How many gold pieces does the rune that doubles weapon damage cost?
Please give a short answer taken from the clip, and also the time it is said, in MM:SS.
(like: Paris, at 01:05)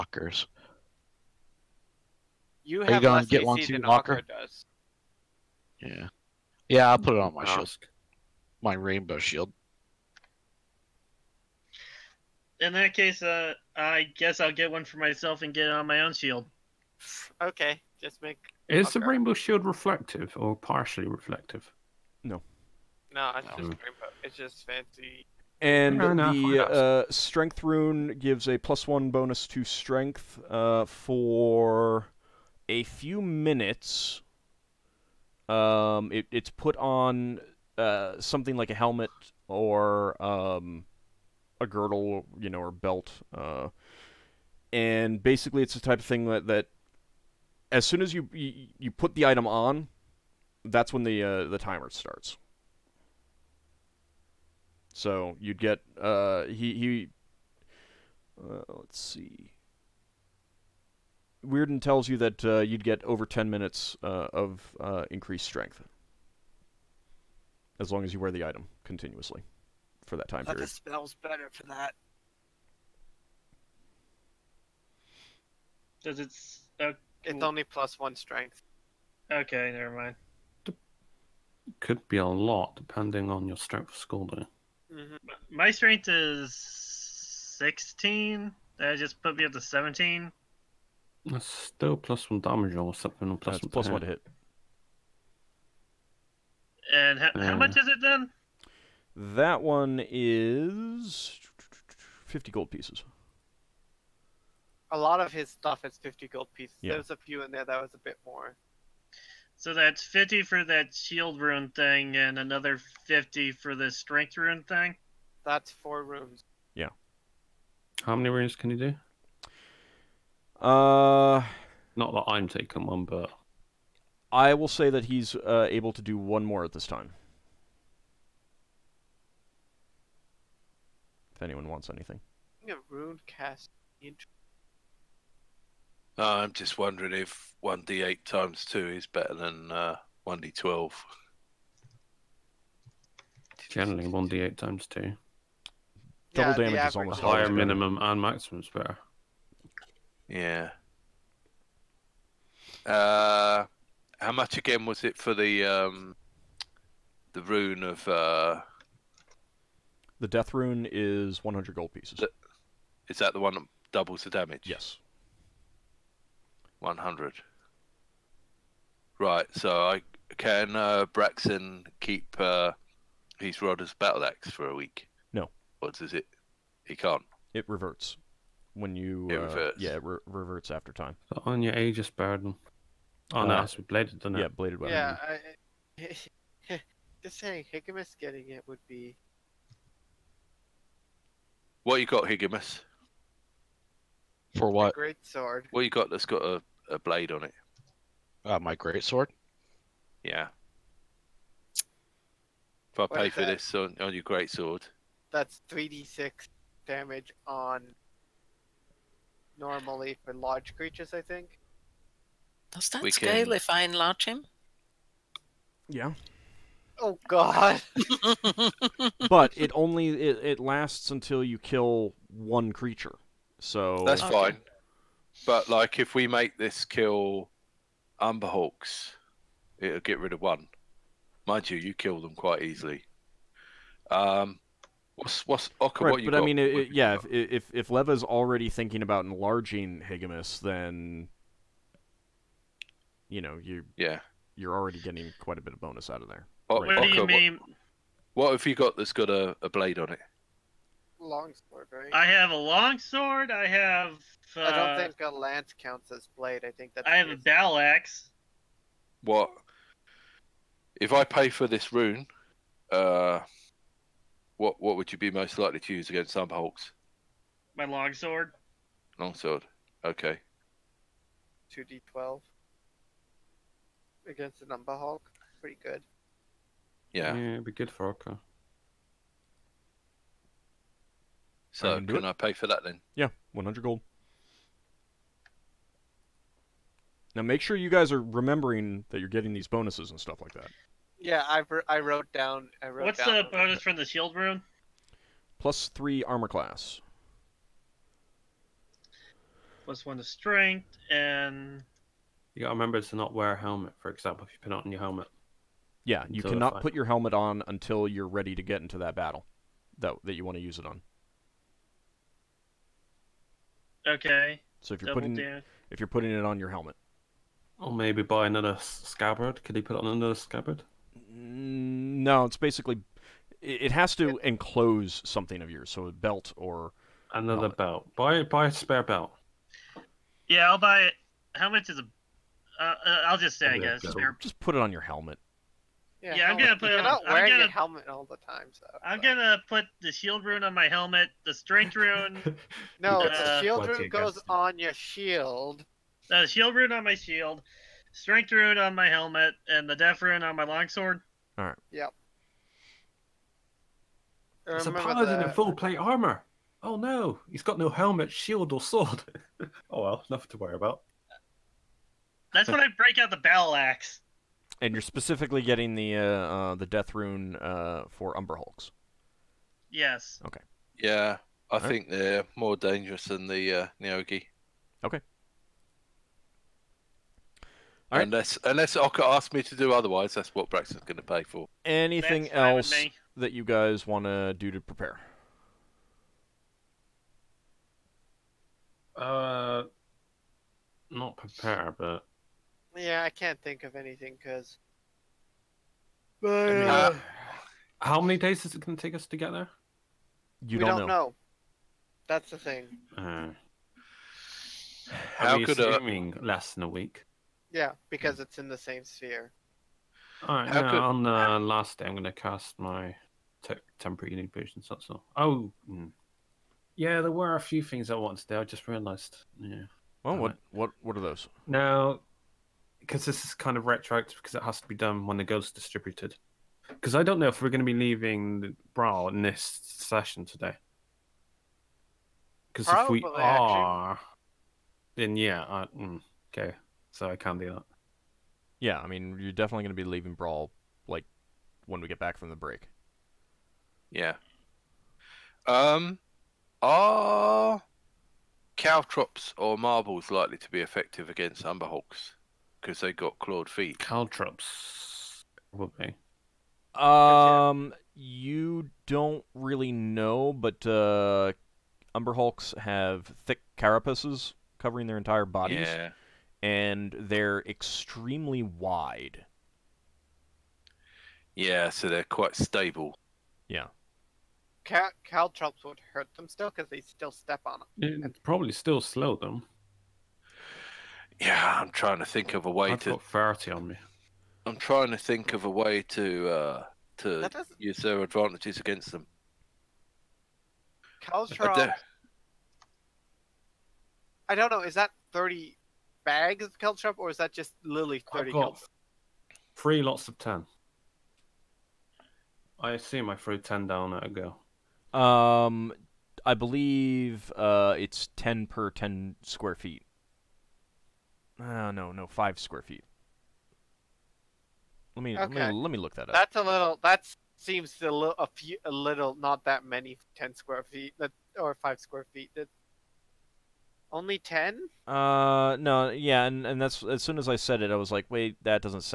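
100, at 02:41.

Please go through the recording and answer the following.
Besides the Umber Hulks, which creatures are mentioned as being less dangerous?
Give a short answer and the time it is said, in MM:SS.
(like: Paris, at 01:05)
Neogi, at 06:13.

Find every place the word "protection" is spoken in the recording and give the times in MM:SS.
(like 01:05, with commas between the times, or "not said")
not said.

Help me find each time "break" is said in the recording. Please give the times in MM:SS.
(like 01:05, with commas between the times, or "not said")
06:02, 07:22.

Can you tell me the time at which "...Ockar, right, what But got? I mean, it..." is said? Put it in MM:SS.
03:55.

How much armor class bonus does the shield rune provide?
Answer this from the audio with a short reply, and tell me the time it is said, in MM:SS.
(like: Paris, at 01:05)
+3, at 04:55.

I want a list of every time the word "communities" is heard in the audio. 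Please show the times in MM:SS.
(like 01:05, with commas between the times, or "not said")
not said.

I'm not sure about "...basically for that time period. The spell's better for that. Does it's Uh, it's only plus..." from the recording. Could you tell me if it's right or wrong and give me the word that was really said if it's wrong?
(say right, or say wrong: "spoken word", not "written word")
wrong: "continuously", not "basically".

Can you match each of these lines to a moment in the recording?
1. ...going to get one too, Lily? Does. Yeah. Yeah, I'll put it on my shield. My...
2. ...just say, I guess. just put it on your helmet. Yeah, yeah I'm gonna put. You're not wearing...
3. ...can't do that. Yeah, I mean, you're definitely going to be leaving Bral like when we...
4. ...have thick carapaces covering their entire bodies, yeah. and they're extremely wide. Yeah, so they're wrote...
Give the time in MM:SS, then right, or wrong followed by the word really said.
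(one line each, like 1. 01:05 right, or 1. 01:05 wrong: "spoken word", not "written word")
1. 00:02 wrong: "Ockar", not "Lily"
2. 05:33 right
3. 07:17 right
4. 07:42 wrong: "quite", not "wrote".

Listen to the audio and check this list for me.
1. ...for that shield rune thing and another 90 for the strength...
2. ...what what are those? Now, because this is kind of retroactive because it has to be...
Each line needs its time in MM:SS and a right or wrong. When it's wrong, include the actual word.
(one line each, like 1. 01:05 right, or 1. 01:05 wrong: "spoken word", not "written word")
1. 01:50 wrong: "50", not "90"
2. 07:00 right.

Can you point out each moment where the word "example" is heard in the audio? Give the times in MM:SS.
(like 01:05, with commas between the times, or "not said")
05:04.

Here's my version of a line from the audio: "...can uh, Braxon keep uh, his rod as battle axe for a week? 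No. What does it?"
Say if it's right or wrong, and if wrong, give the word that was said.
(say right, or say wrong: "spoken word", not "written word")
right.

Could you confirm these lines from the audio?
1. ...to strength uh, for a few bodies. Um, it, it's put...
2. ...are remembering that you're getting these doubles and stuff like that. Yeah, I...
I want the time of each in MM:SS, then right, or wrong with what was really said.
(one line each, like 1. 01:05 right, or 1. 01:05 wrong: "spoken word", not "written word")
1. 00:29 wrong: "minutes", not "bodies"
2. 04:48 wrong: "bonuses", not "doubles".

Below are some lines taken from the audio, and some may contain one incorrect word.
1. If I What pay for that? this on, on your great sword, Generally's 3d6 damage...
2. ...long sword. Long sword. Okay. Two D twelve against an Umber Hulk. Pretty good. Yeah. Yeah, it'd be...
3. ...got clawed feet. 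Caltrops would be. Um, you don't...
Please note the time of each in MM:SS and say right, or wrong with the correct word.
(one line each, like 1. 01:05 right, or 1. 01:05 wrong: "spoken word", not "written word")
1. 03:22 wrong: "That", not "Generally"
2. 04:27 right
3. 07:33 right.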